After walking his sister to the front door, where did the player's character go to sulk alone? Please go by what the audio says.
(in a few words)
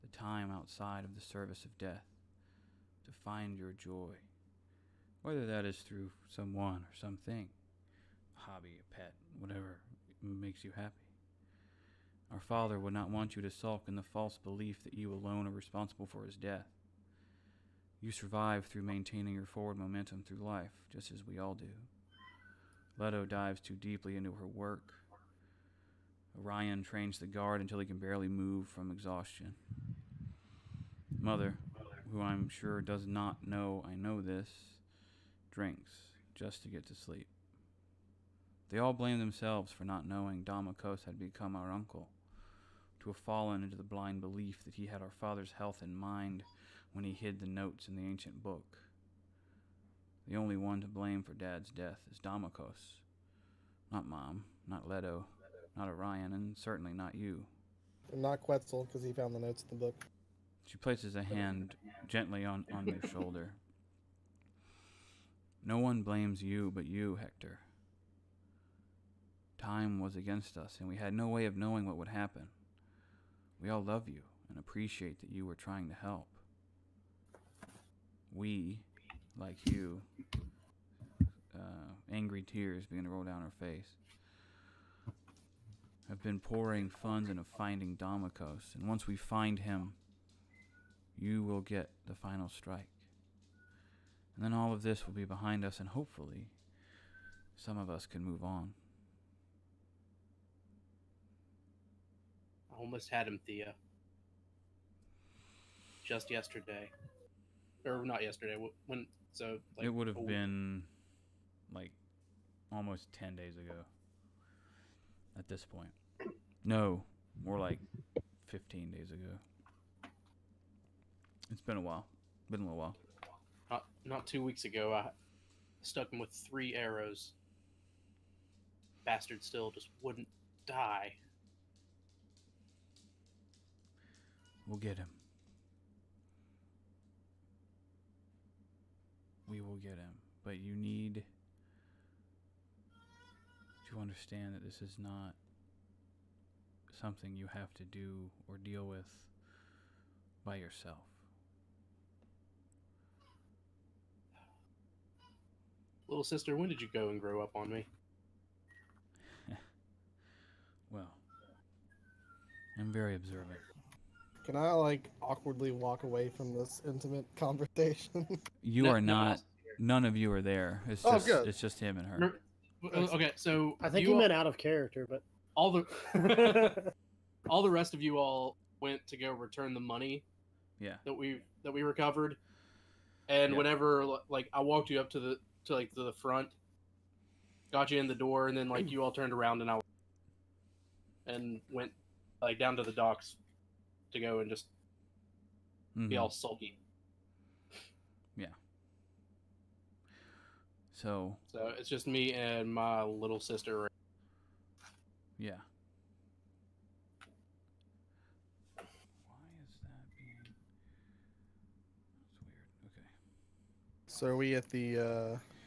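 the docks.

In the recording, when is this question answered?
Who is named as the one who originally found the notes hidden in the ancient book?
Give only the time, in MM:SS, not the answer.
00:58.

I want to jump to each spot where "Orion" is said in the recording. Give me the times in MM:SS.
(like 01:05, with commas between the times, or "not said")
00:26, 00:55.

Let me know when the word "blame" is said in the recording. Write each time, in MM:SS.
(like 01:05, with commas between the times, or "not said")
00:38, 00:50, 01:06.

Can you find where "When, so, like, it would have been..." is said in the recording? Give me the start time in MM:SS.
01:48.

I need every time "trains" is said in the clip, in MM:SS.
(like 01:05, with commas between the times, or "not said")
00:26.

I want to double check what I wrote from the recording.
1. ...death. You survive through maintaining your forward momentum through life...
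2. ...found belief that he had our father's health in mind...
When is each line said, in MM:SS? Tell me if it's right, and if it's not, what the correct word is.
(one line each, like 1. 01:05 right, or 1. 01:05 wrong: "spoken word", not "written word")
1. 00:16 right
2. 00:43 wrong: "blind", not "found".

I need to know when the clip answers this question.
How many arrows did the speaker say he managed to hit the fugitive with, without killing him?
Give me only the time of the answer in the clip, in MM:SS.
02:06.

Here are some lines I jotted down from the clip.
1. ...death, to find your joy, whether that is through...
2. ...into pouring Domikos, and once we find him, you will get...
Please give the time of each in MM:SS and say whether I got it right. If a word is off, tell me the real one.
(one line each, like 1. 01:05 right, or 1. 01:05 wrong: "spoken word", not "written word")
1. 00:01 right
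2. 01:27 wrong: "finding", not "pouring".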